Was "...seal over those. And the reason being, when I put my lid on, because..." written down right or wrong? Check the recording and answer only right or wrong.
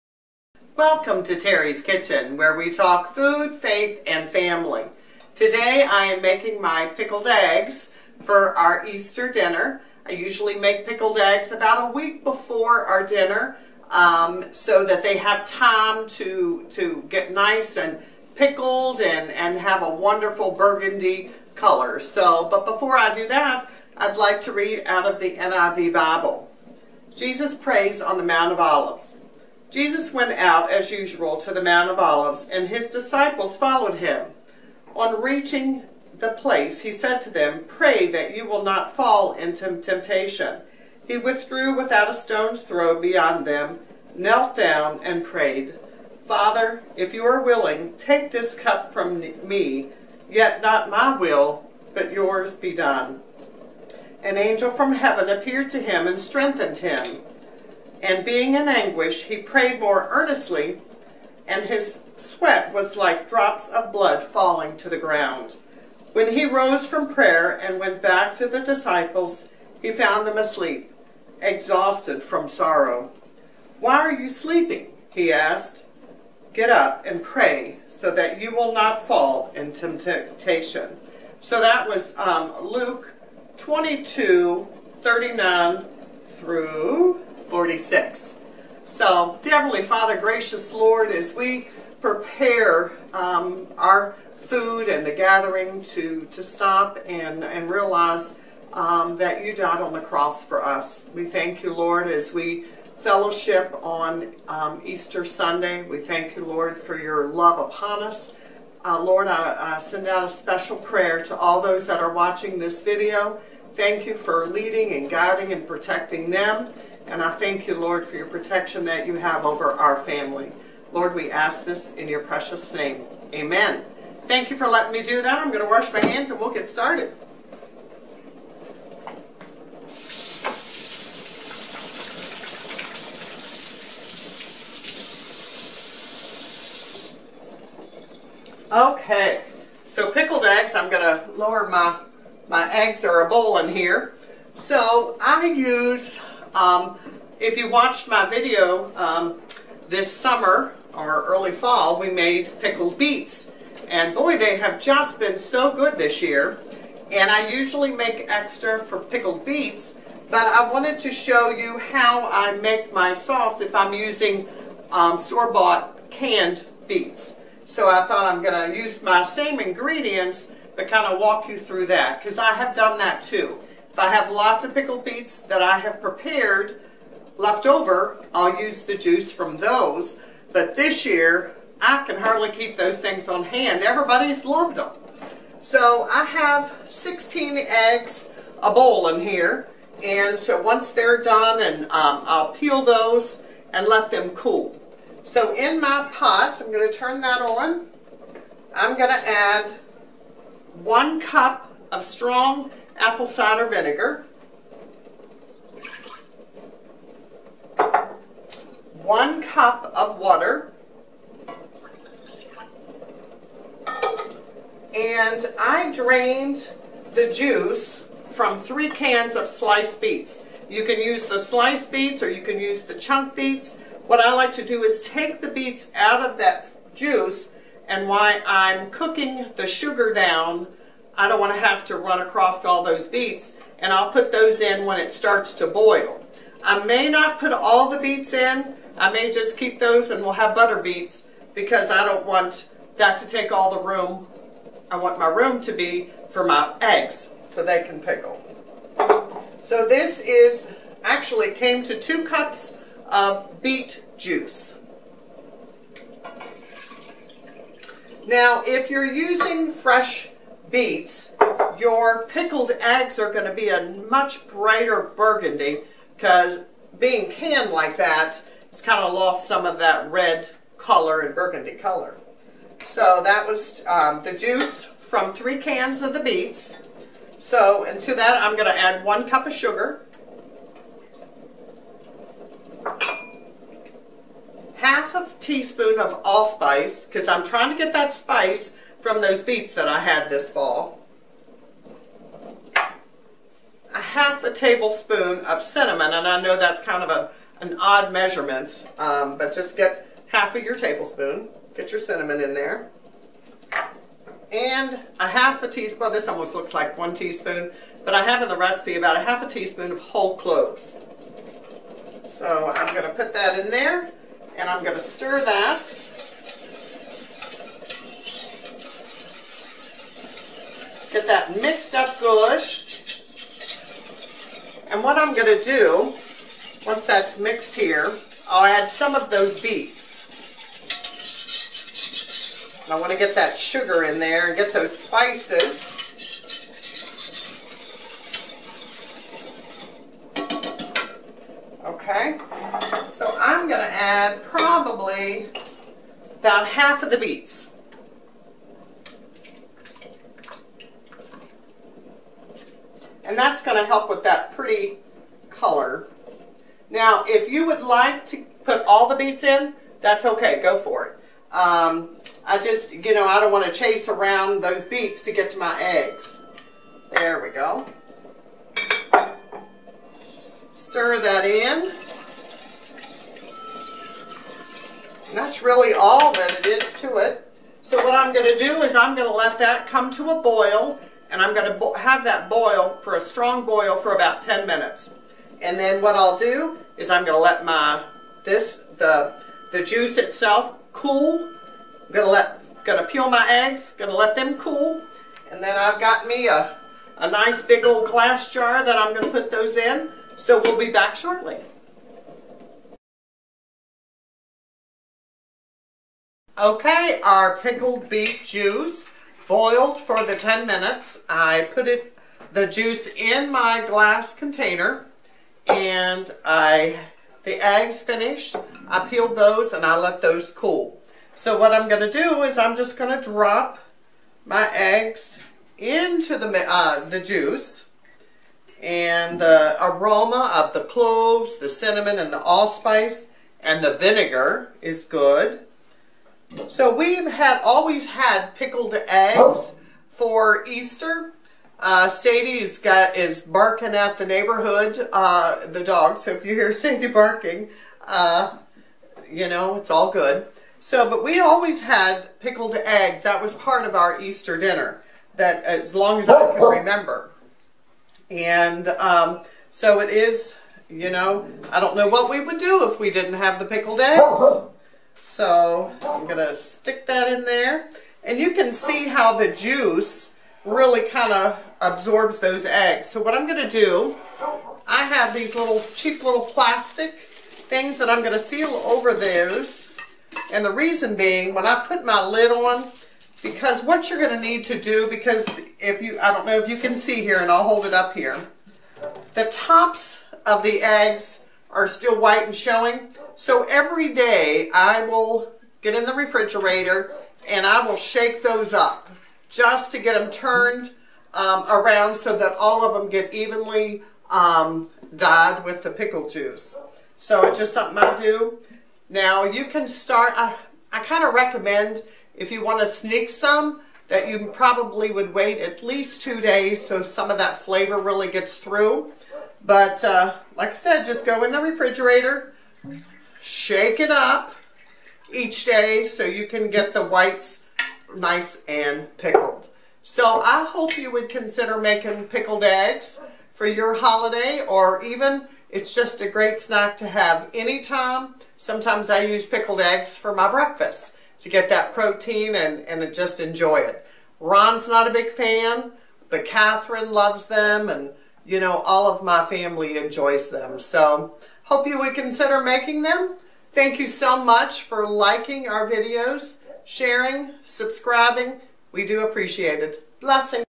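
right.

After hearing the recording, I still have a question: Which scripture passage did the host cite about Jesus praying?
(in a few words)
Luke 22:39-46.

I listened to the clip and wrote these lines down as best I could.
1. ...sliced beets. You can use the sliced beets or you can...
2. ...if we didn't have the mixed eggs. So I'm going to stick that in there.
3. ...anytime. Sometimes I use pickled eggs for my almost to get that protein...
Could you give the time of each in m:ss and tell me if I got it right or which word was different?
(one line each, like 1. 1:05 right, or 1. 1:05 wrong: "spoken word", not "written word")
1. 3:39 right
2. 7:42 wrong: "pickled", not "mixed"
3. 8:57 wrong: "breakfast", not "almost".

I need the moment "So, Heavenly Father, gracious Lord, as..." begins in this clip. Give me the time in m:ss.
1:28.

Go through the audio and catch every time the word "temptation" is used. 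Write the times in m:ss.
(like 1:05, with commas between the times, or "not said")
0:39, 1:19.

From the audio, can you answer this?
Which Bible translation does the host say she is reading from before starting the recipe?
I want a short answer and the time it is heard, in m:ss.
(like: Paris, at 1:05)
NIV, at 0:25.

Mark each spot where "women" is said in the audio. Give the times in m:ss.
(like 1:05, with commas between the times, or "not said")
not said.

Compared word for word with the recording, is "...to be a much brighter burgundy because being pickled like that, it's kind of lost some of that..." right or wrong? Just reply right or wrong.
wrong.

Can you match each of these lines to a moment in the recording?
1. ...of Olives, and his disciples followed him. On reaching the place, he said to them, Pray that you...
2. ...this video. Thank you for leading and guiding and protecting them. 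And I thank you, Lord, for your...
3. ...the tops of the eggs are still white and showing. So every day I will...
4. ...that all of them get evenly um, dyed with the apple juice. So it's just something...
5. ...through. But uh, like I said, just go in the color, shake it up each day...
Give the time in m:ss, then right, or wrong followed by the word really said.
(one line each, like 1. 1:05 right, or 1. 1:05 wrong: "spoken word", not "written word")
1. 0:31 right
2. 1:52 right
3. 8:09 right
4. 8:22 wrong: "pickle", not "apple"
5. 8:38 wrong: "refrigerator", not "color".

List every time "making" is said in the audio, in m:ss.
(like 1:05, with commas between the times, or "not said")
0:06, 8:51, 9:12.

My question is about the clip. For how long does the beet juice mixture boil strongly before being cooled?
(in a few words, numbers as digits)
10 minutes.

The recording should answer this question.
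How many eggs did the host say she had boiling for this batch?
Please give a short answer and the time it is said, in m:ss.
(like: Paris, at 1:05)
16, at 3:06.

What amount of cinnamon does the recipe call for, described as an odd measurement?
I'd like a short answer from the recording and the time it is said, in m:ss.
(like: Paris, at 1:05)
half a tablespoon, at 4:53.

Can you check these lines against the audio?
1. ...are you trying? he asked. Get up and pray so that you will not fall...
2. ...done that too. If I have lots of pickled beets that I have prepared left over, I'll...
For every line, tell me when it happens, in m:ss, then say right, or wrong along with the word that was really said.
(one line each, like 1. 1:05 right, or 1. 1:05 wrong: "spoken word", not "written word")
1. 1:13 wrong: "sleeping", not "trying"
2. 2:52 right.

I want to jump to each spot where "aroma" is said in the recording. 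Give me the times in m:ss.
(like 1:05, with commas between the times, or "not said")
7:09.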